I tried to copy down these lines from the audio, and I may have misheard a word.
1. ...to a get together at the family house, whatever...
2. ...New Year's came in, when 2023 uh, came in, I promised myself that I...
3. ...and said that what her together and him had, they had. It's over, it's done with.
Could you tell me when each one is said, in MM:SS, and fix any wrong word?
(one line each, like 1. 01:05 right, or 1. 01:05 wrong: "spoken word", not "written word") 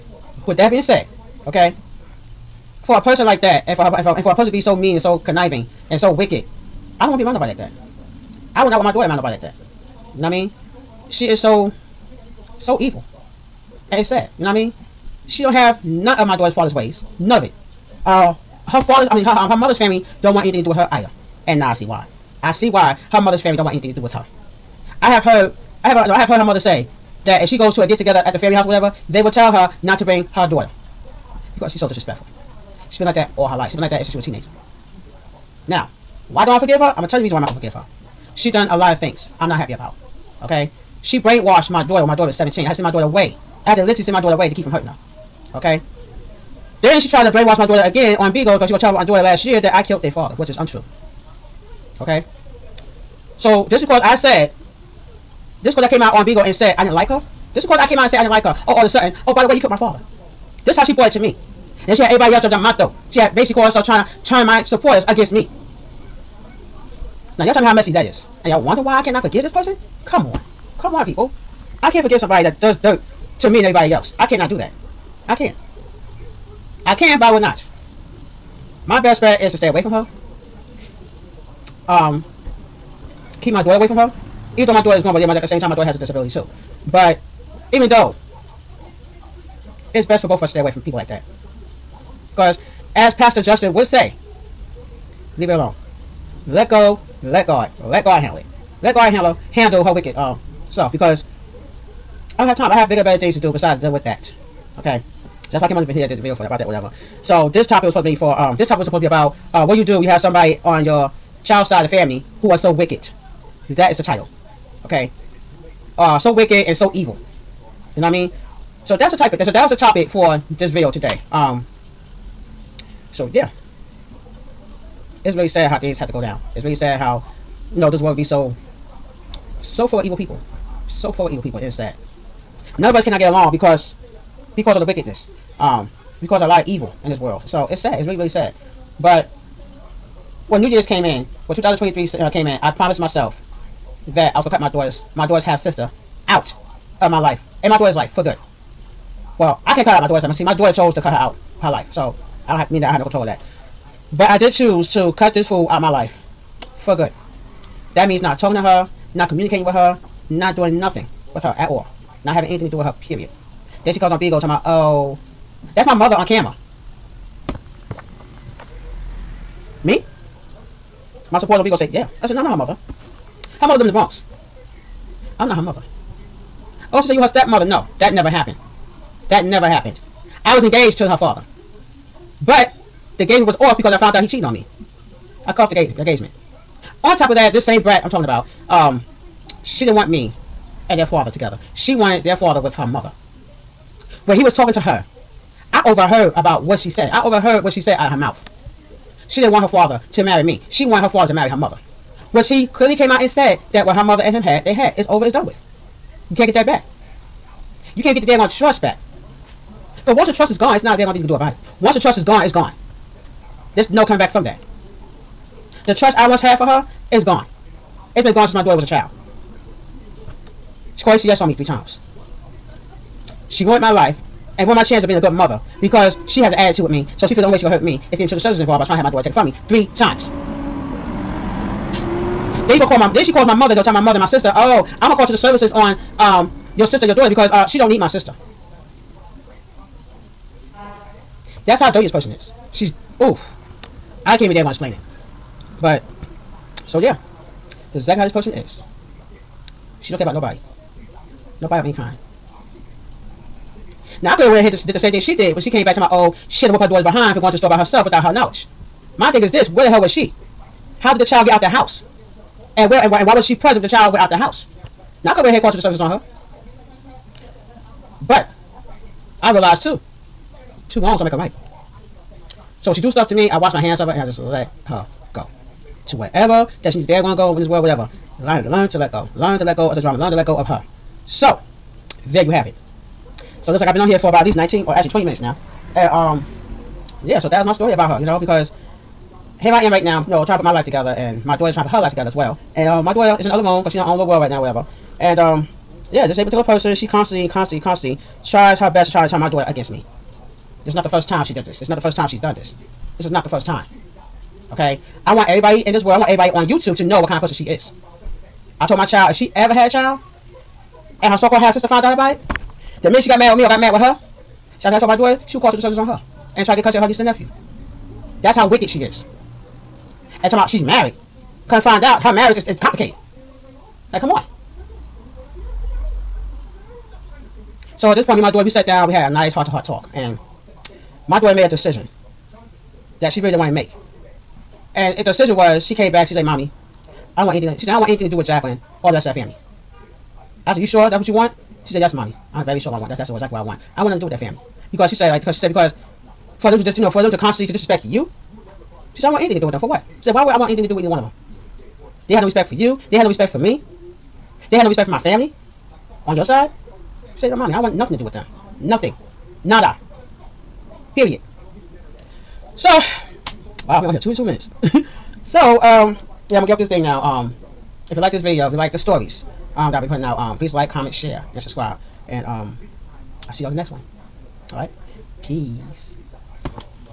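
1. 00:27 right
2. 02:20 right
3. 03:23 wrong: "mother", not "together".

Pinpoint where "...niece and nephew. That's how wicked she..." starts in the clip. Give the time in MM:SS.
05:17.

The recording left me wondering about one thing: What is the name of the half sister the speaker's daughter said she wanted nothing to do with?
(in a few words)
Jacqueline.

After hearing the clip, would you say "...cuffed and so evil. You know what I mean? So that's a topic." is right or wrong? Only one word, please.
wrong.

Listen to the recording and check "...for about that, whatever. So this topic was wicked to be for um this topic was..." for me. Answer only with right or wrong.
wrong.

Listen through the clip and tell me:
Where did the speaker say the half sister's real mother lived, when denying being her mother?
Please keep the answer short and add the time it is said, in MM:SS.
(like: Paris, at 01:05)
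the Bronx, at 02:53.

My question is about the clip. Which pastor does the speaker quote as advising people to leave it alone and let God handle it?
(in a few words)
Pastor Justin.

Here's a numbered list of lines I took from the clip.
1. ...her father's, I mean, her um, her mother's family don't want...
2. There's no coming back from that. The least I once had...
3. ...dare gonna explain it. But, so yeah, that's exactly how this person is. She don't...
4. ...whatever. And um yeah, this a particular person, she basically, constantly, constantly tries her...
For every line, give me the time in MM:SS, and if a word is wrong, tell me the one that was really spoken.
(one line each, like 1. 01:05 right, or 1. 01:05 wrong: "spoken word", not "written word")
1. 00:18 right
2. 03:33 wrong: "trust", not "least"
3. 04:04 right
4. 04:54 wrong: "constantly", not "basically".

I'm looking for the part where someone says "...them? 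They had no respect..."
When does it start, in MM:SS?
05:51.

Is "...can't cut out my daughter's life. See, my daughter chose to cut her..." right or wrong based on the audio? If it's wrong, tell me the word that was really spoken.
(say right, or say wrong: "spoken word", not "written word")
right.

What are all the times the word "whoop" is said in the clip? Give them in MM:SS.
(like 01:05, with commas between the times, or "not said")
04:16.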